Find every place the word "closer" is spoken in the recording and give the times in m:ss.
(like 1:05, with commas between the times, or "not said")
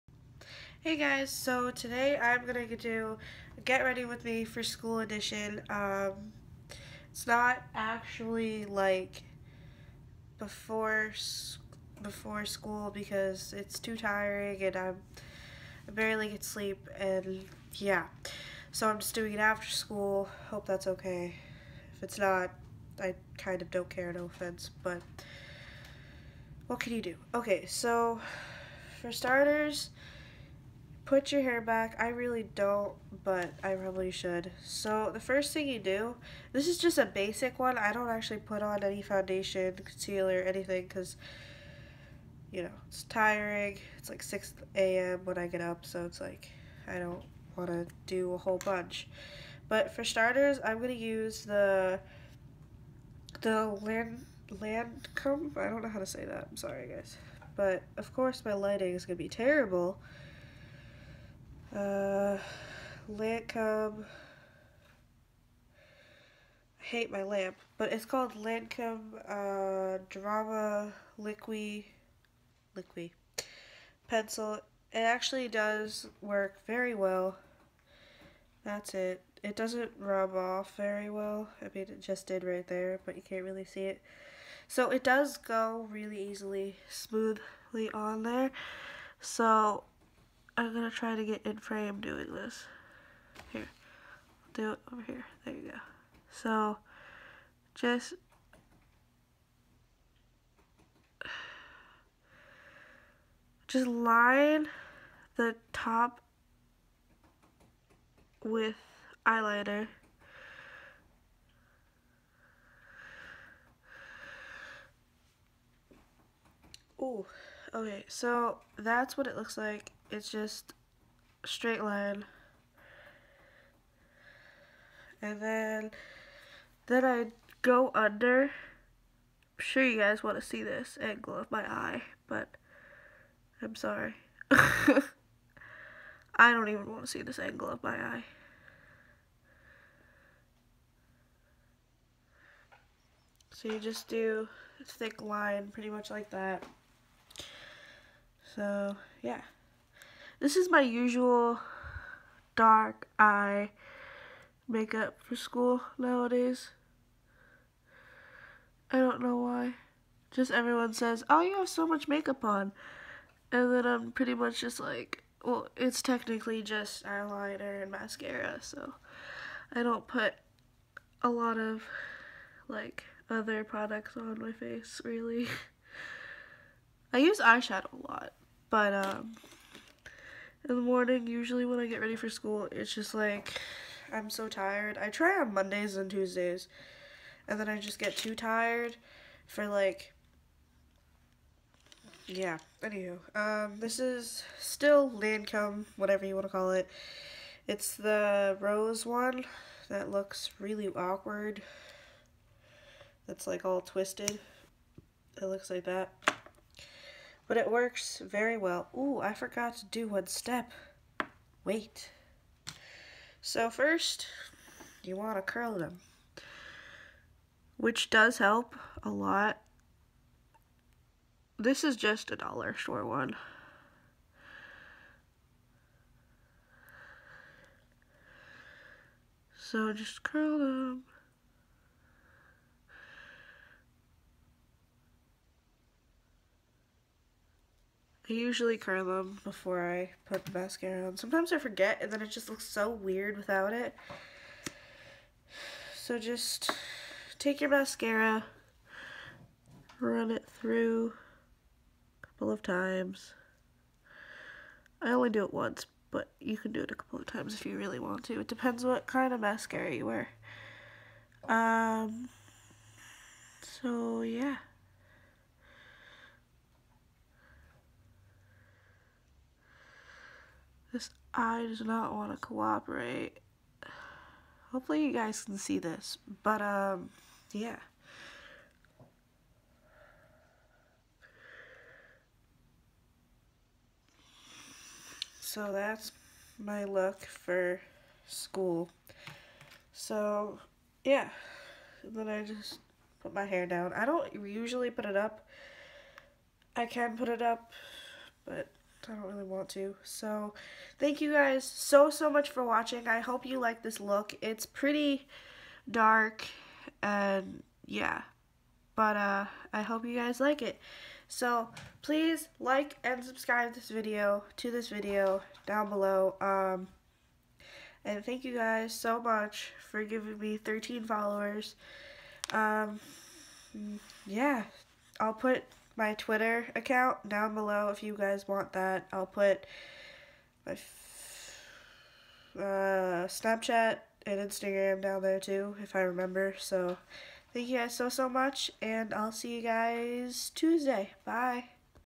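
not said.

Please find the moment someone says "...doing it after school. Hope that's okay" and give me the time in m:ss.
0:19.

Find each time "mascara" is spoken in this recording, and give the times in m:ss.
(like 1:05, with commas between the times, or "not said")
2:47, 4:00, 4:07, 4:19.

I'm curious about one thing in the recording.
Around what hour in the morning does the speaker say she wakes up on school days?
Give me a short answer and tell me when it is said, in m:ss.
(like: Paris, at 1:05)
6 a.m., at 0:44.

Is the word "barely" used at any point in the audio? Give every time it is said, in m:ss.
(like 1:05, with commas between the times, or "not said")
0:15.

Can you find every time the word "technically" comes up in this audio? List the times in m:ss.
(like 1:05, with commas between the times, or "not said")
2:46.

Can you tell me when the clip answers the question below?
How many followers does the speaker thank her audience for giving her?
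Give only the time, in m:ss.
5:20.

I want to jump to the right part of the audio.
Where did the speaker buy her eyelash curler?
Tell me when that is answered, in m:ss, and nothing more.
3:42.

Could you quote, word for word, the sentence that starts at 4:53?
I don't usually put it up.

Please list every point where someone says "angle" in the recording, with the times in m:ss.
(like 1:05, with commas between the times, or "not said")
2:10, 2:17.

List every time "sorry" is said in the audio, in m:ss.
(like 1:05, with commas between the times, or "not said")
0:56, 2:13.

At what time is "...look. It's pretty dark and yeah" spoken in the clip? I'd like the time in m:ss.
5:03.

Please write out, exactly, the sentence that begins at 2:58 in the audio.
But um, in the morning, usually when I get ready for school, it's just like I'm so tired.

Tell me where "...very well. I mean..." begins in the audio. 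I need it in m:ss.
1:20.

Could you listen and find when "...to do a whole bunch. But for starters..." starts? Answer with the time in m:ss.
0:47.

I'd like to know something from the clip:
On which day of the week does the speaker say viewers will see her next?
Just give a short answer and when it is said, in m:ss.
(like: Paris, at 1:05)
Tuesday, at 5:40.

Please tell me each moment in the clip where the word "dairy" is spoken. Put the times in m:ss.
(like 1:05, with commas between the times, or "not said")
not said.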